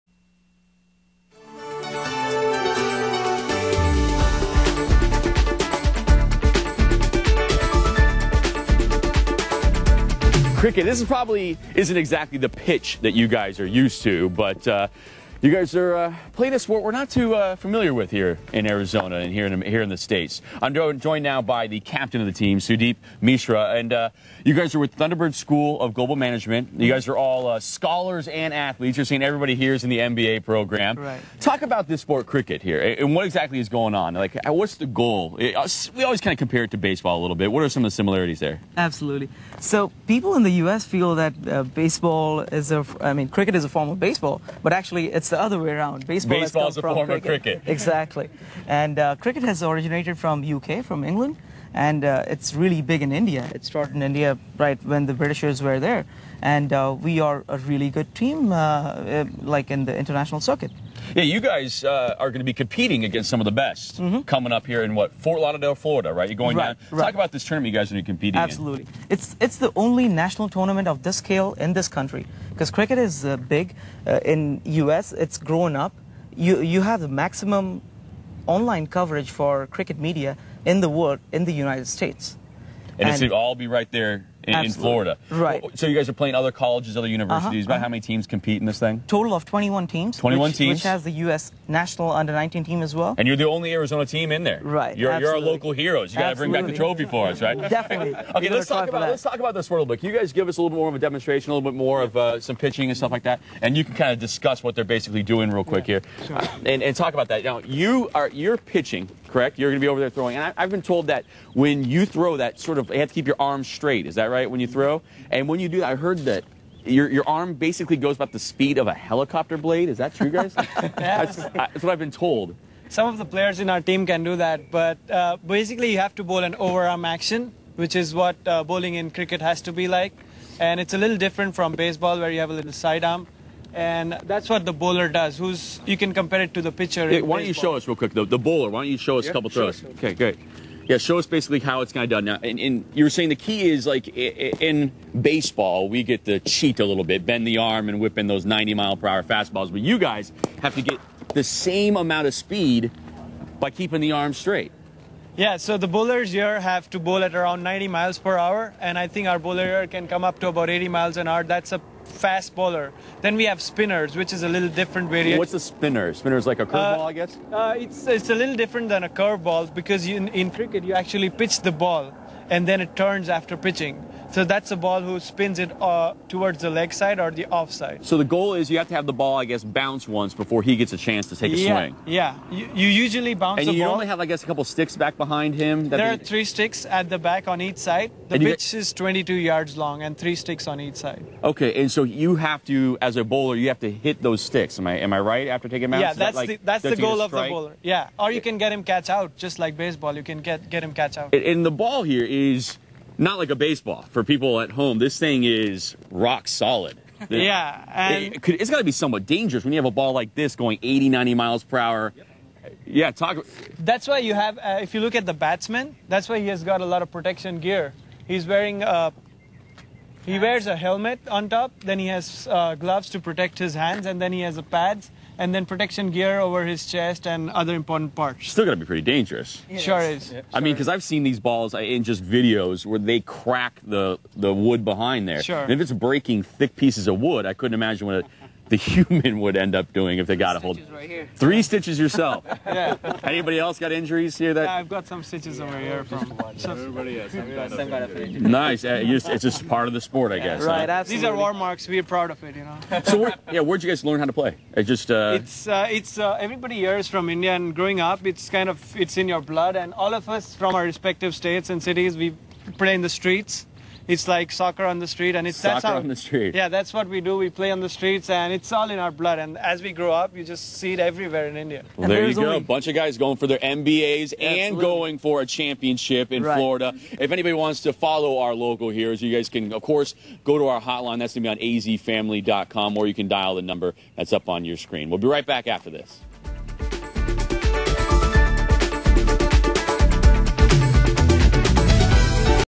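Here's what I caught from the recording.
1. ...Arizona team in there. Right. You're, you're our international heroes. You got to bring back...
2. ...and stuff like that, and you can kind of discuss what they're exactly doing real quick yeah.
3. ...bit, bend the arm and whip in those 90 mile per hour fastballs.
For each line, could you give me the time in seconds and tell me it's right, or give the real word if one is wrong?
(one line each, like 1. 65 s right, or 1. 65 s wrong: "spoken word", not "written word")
1. 93 s wrong: "local", not "international"
2. 102 s wrong: "basically", not "exactly"
3. 147 s right.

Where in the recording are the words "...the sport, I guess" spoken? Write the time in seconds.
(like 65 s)
249 s.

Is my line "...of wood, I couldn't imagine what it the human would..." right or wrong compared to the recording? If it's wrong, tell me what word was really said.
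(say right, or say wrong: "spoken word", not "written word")
right.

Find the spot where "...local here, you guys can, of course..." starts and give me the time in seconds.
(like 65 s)
278 s.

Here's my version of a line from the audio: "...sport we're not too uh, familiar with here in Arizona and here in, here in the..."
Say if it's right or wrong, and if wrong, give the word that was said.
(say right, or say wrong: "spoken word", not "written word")
right.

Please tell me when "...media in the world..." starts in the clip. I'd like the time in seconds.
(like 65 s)
79 s.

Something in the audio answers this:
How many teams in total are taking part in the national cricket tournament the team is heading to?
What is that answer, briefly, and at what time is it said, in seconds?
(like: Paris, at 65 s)
21, at 89 s.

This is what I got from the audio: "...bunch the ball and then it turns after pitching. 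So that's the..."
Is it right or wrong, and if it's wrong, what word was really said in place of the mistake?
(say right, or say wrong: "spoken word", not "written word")
wrong: "pitch", not "bunch".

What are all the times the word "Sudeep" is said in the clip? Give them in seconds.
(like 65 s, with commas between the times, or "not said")
22 s.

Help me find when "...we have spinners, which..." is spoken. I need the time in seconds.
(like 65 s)
163 s.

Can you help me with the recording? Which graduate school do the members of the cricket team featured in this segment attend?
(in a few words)
Thunderbird School of Global Management.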